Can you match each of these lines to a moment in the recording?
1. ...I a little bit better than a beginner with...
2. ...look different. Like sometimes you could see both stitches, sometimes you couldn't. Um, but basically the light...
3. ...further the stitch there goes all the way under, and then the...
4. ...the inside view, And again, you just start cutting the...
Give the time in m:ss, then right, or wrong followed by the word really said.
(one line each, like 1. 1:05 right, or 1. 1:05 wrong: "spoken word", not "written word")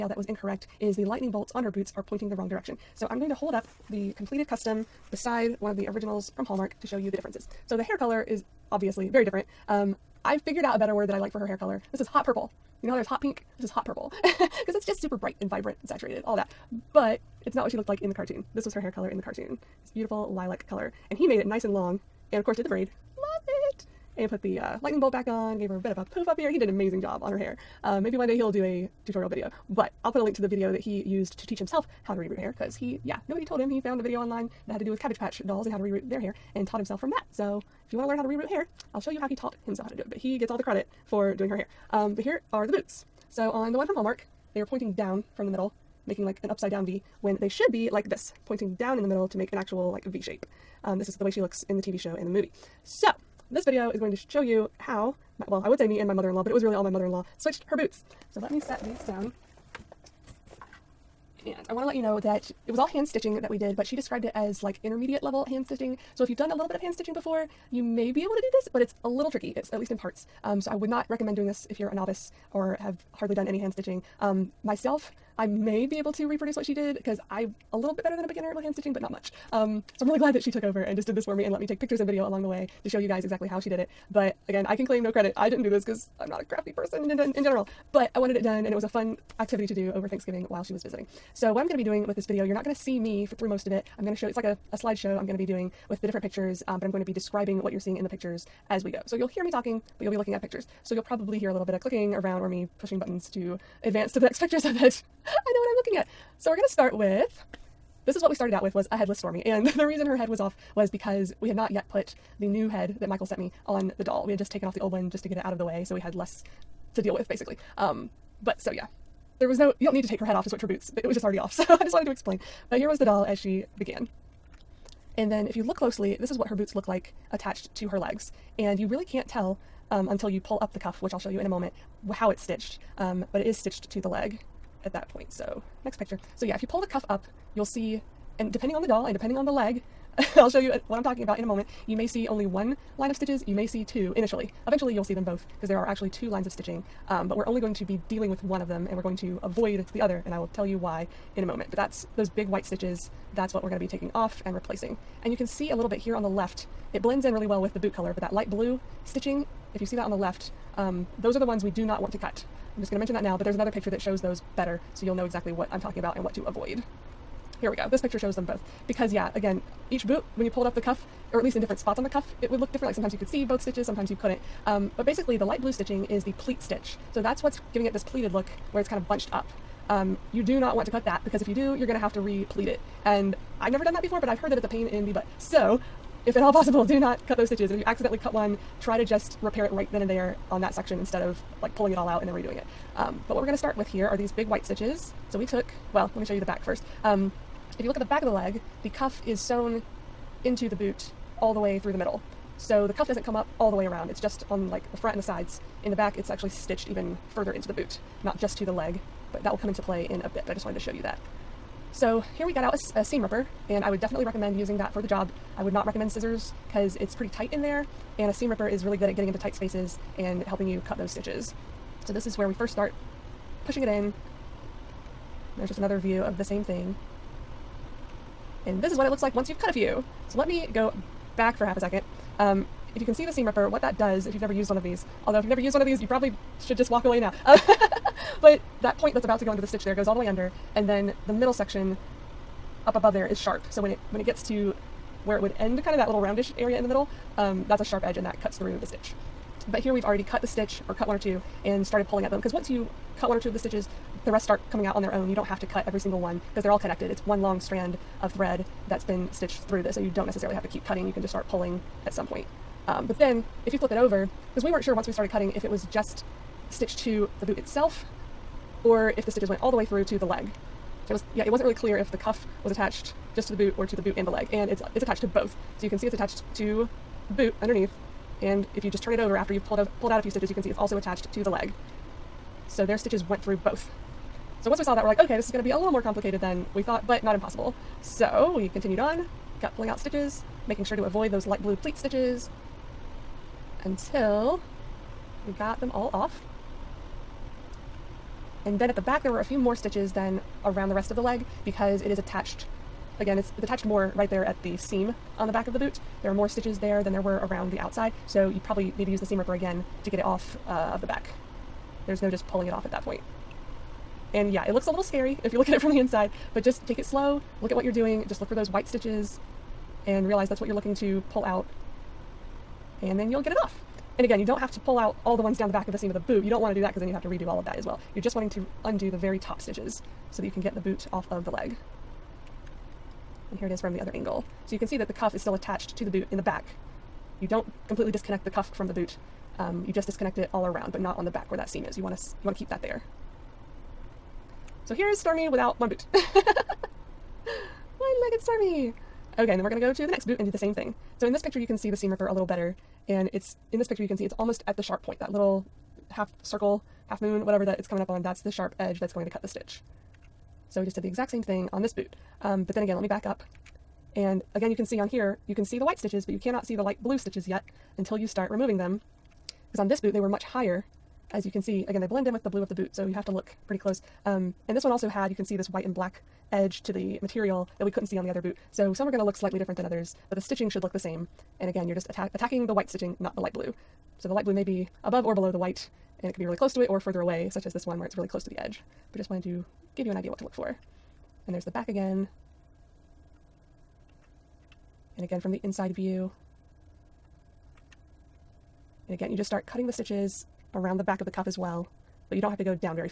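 1. 1:17 right
2. 2:52 right
3. 3:59 wrong: "under", not "further"
4. 6:35 right.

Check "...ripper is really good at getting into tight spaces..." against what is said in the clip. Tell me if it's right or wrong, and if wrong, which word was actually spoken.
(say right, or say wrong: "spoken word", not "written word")
right.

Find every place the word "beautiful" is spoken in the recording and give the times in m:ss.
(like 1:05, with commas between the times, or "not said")
0:19.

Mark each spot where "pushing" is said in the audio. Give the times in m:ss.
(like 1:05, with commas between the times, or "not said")
1:42, 3:43.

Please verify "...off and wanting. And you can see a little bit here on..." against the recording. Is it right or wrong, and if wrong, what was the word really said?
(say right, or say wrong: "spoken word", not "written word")
wrong: "replacing", not "wanting".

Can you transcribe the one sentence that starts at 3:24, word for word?
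It's just on like the front and the sides.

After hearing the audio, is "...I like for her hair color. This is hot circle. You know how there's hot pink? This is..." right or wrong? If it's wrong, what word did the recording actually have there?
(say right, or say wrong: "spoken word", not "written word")
wrong: "purple", not "circle".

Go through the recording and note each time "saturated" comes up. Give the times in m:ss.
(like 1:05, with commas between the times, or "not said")
0:15.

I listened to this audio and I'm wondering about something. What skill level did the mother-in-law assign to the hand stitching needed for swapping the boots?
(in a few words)
Intermediate.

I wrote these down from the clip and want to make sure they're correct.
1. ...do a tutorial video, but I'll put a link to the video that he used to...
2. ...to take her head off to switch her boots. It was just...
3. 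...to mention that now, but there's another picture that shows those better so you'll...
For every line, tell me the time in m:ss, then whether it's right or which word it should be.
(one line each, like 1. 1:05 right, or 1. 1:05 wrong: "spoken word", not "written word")
1. 0:28 right
2. 2:00 right
3. 2:42 right.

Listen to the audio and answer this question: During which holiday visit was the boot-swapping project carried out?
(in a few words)
Thanksgiving.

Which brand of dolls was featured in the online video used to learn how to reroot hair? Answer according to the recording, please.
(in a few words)
Cabbage Patch.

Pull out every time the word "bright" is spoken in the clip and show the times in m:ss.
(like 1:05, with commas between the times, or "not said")
0:15.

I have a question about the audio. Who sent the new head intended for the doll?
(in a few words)
Mikel.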